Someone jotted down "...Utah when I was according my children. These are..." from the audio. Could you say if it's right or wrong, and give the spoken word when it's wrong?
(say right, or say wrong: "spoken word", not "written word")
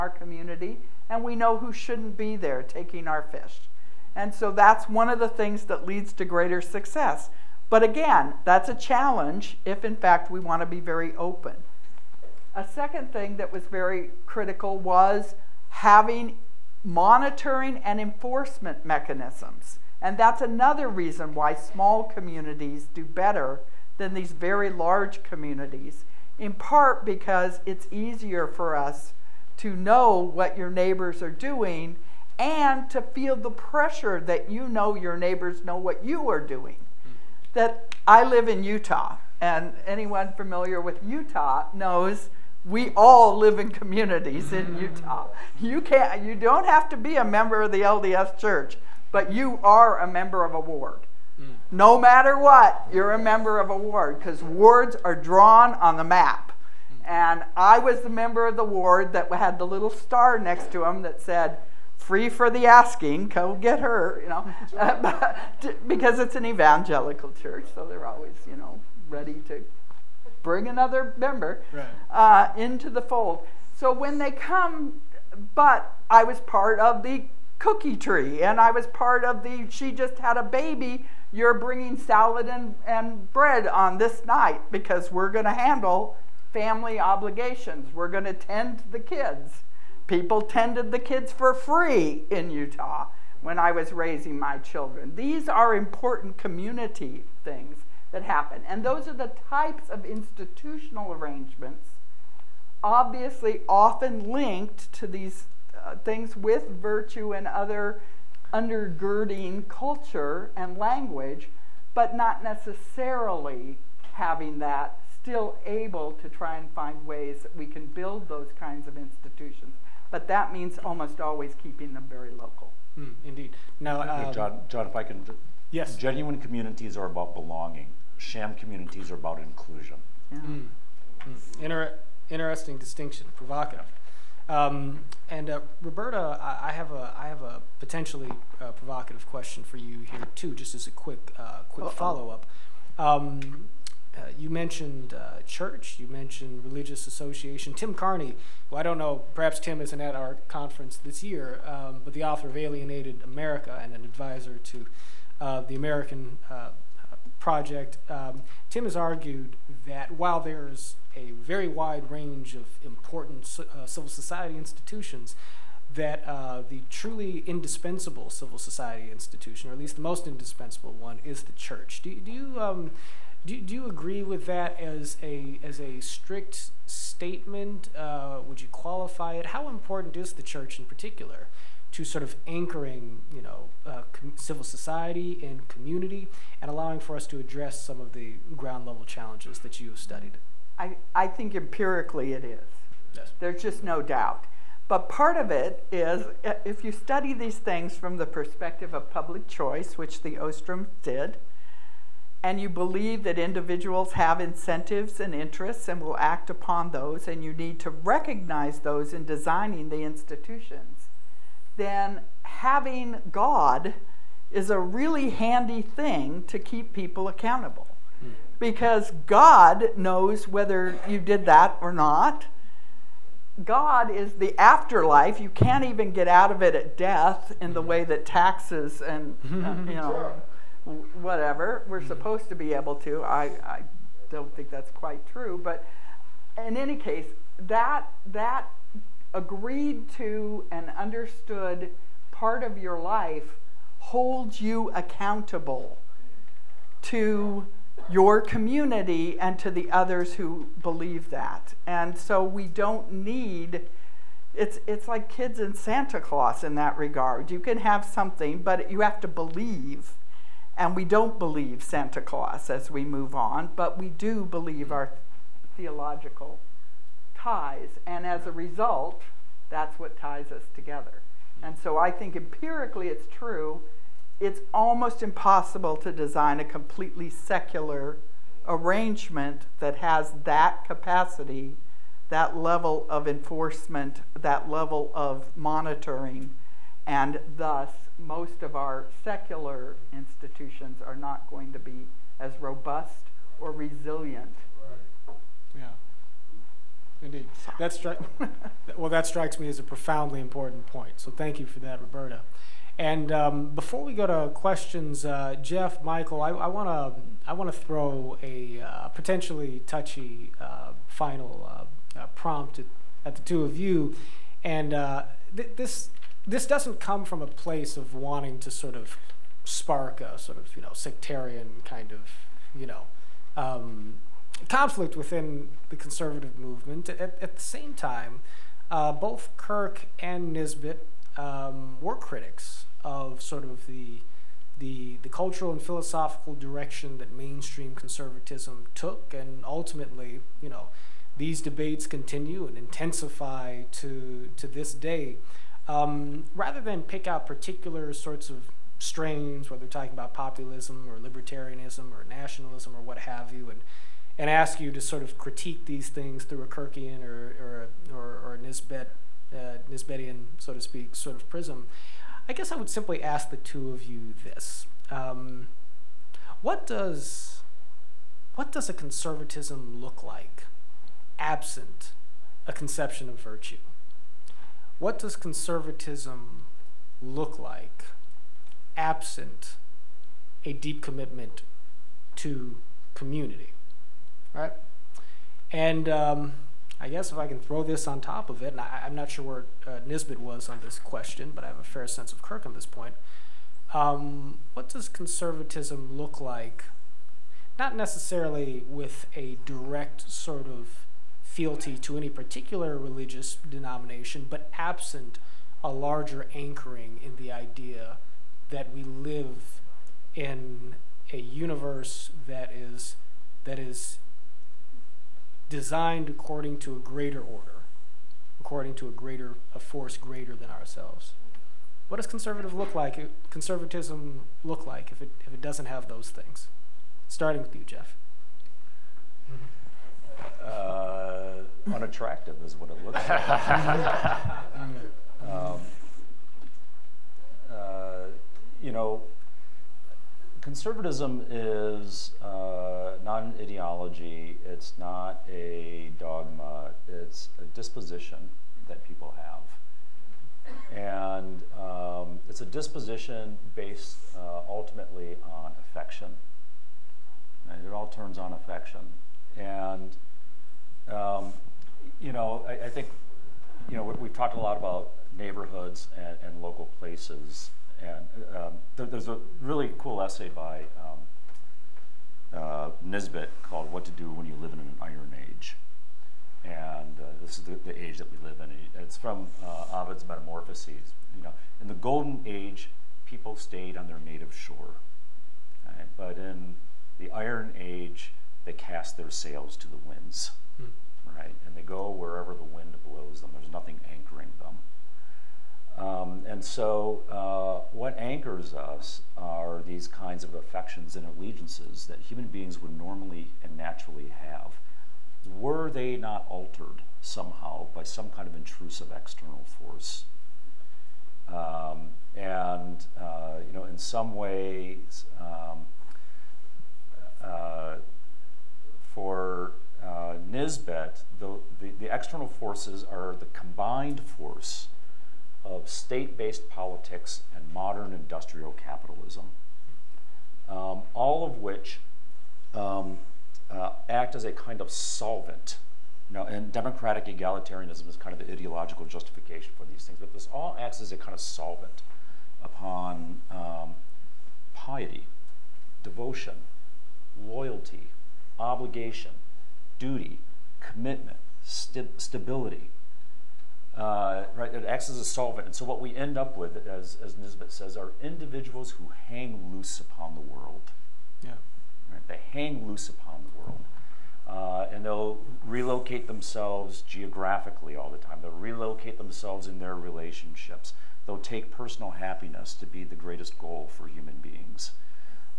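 wrong: "raising", not "according".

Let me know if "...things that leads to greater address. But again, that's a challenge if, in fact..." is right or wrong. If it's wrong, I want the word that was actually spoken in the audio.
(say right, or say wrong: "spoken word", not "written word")
wrong: "success", not "address".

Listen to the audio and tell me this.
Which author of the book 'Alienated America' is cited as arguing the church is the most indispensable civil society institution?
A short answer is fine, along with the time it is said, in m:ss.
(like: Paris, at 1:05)
Tim Carney, at 2:27.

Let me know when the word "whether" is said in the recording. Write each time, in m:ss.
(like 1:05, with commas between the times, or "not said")
3:40, 5:49.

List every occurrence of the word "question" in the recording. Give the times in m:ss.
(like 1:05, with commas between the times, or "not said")
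2:19, 5:04, 6:30.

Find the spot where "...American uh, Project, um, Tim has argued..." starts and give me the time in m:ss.
2:35.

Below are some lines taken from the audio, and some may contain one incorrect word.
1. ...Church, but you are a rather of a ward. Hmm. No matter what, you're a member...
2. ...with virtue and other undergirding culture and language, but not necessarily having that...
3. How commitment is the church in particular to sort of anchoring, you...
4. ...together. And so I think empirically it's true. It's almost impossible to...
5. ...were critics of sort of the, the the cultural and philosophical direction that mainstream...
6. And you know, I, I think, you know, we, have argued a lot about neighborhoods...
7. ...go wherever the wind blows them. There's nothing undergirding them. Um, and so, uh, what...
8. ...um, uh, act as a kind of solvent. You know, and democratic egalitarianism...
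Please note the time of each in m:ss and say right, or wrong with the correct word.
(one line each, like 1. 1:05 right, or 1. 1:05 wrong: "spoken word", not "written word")
1. 0:48 wrong: "member", not "rather"
2. 1:46 right
3. 2:59 wrong: "important", not "commitment"
4. 4:30 right
5. 5:32 right
6. 7:39 wrong: "talked", not "argued"
7. 8:11 wrong: "anchoring", not "undergirding"
8. 8:52 right.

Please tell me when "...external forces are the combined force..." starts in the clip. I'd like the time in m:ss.
8:42.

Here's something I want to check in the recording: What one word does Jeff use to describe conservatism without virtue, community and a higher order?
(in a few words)
unattractive.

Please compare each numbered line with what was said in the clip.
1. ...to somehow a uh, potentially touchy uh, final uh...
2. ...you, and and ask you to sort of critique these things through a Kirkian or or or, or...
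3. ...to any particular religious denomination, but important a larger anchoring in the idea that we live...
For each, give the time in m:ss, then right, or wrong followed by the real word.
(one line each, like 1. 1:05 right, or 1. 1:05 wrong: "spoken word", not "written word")
1. 5:07 wrong: "throw", not "somehow"
2. 5:53 right
3. 6:41 wrong: "absent", not "important".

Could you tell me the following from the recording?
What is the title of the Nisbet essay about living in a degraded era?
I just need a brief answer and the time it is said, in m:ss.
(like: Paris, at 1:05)
What to Do When You Live in an Iron Age, at 7:53.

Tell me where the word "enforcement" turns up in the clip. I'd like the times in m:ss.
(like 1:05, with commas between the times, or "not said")
0:17, 4:43.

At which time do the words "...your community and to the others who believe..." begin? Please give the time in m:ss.
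4:08.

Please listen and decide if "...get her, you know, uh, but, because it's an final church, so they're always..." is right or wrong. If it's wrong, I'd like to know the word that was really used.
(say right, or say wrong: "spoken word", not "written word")
wrong: "evangelical", not "final".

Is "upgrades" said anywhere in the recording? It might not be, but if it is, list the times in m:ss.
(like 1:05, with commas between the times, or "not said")
not said.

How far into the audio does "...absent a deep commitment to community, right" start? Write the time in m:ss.
6:18.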